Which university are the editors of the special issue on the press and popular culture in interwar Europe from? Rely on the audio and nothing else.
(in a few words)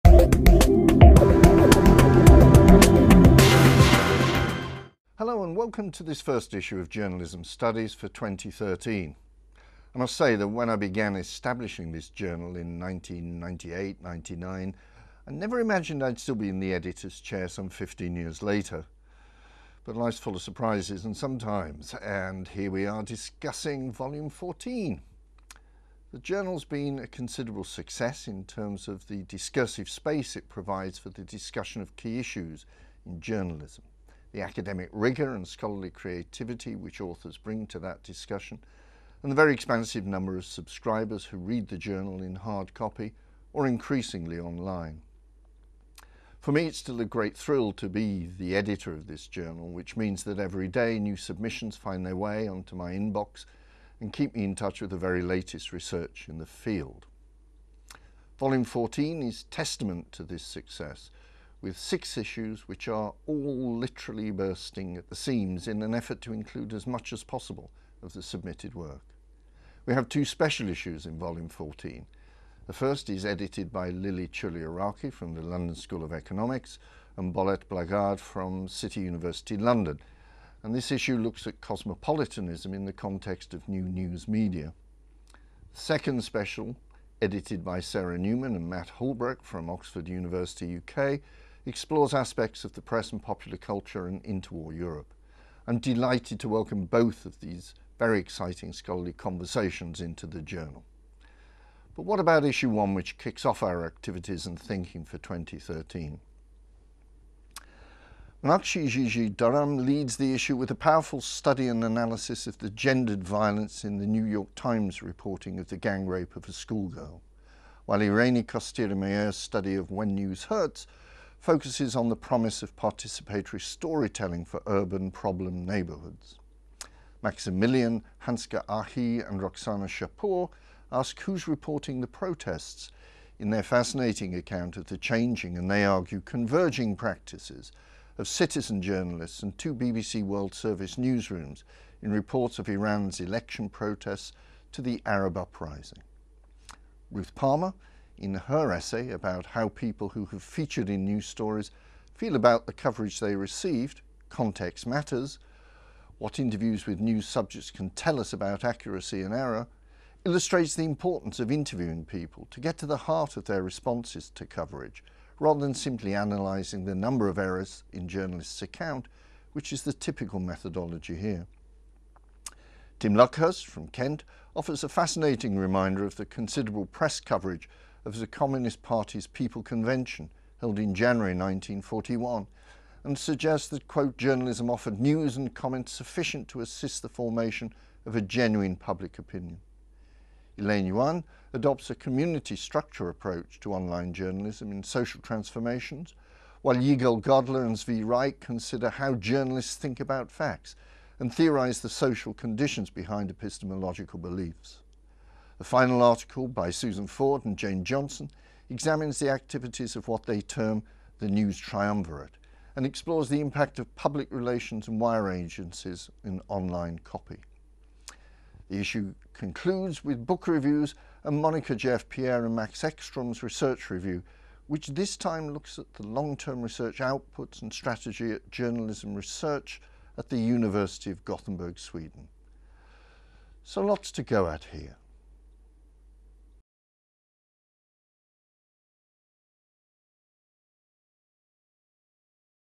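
Oxford University.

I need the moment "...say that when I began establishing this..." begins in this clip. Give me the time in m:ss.
0:10.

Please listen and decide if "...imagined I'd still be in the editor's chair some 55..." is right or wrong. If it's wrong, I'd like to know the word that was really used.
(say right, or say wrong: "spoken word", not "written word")
wrong: "15", not "55".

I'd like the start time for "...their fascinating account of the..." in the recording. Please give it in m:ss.
2:13.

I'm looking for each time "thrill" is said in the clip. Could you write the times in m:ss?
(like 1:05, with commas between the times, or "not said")
0:47.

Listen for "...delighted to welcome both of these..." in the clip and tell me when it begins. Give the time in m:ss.
1:35.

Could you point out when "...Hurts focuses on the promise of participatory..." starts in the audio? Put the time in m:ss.
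2:00.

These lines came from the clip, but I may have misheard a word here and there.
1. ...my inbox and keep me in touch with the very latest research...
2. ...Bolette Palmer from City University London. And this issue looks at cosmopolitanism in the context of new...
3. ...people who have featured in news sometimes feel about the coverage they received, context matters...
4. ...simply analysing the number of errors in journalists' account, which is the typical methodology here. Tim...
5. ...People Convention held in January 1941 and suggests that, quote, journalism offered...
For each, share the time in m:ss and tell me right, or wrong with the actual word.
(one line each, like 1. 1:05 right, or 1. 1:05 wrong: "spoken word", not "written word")
1. 0:52 right
2. 1:17 wrong: "Blaagaard", not "Palmer"
3. 2:29 wrong: "stories", not "sometimes"
4. 2:45 right
5. 2:59 right.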